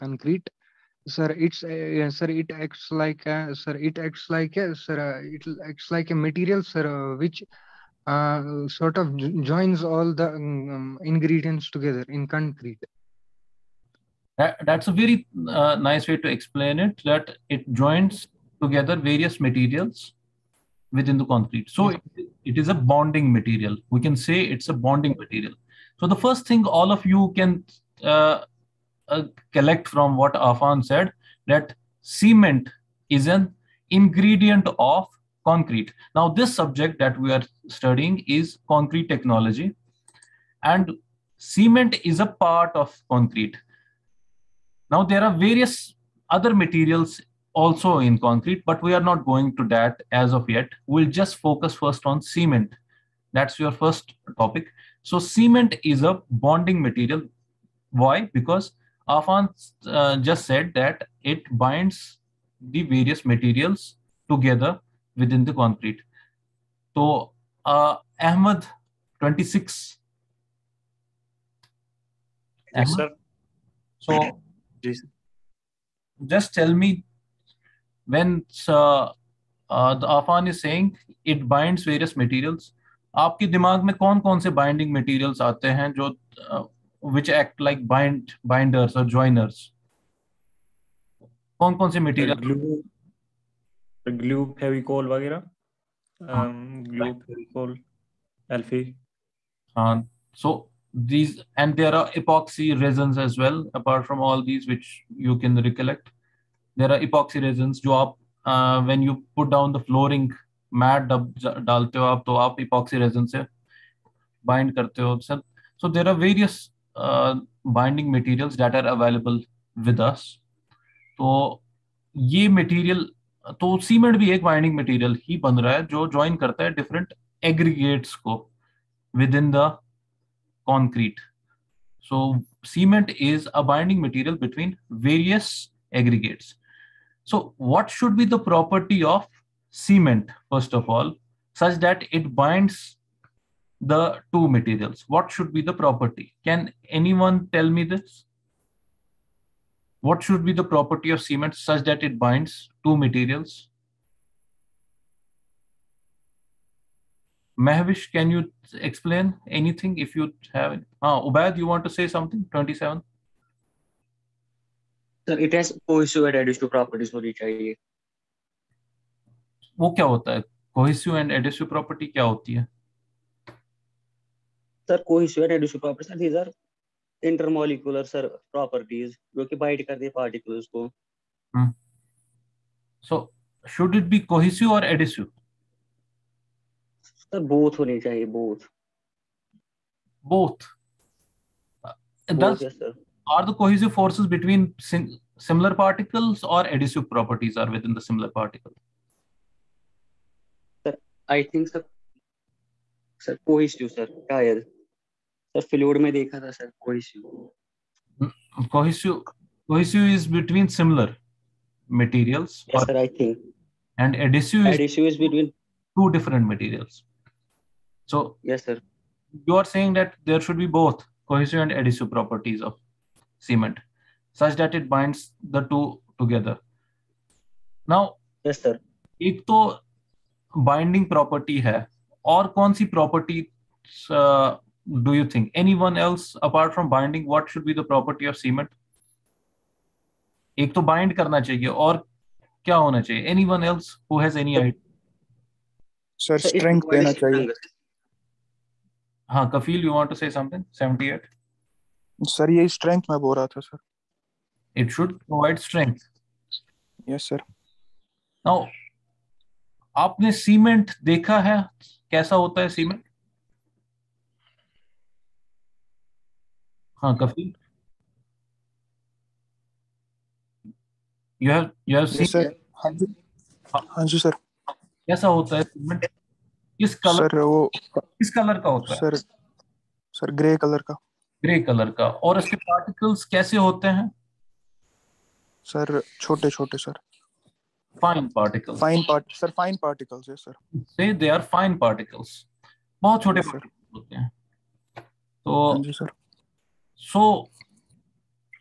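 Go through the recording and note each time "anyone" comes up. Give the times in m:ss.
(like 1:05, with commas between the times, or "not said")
2:26, 3:55, 4:03.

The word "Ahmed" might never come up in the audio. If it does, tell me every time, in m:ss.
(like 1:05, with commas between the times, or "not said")
1:08.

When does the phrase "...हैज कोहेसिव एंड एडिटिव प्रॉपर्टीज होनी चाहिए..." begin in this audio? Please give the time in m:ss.
2:45.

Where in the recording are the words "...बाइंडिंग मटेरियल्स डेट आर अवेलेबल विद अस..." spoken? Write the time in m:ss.
1:57.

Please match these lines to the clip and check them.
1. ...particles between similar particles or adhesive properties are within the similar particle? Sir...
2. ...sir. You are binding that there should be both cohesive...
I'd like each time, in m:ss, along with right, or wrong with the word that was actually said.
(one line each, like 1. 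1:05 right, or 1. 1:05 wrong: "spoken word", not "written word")
1. 3:13 wrong: "forces", not "particles"
2. 3:38 wrong: "saying", not "binding".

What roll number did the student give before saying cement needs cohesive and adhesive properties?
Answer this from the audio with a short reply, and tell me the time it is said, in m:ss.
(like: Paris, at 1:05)
27, at 2:42.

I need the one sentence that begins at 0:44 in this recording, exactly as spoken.
Now there are various other materials also in concrete, but we are not going to that as of yet.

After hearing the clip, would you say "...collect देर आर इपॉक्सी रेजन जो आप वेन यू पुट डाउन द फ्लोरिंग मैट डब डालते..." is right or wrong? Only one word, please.
wrong.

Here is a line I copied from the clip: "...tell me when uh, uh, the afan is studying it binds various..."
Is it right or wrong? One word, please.
wrong.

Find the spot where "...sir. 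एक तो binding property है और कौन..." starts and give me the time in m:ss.
3:48.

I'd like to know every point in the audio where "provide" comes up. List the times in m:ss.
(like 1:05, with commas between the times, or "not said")
4:15.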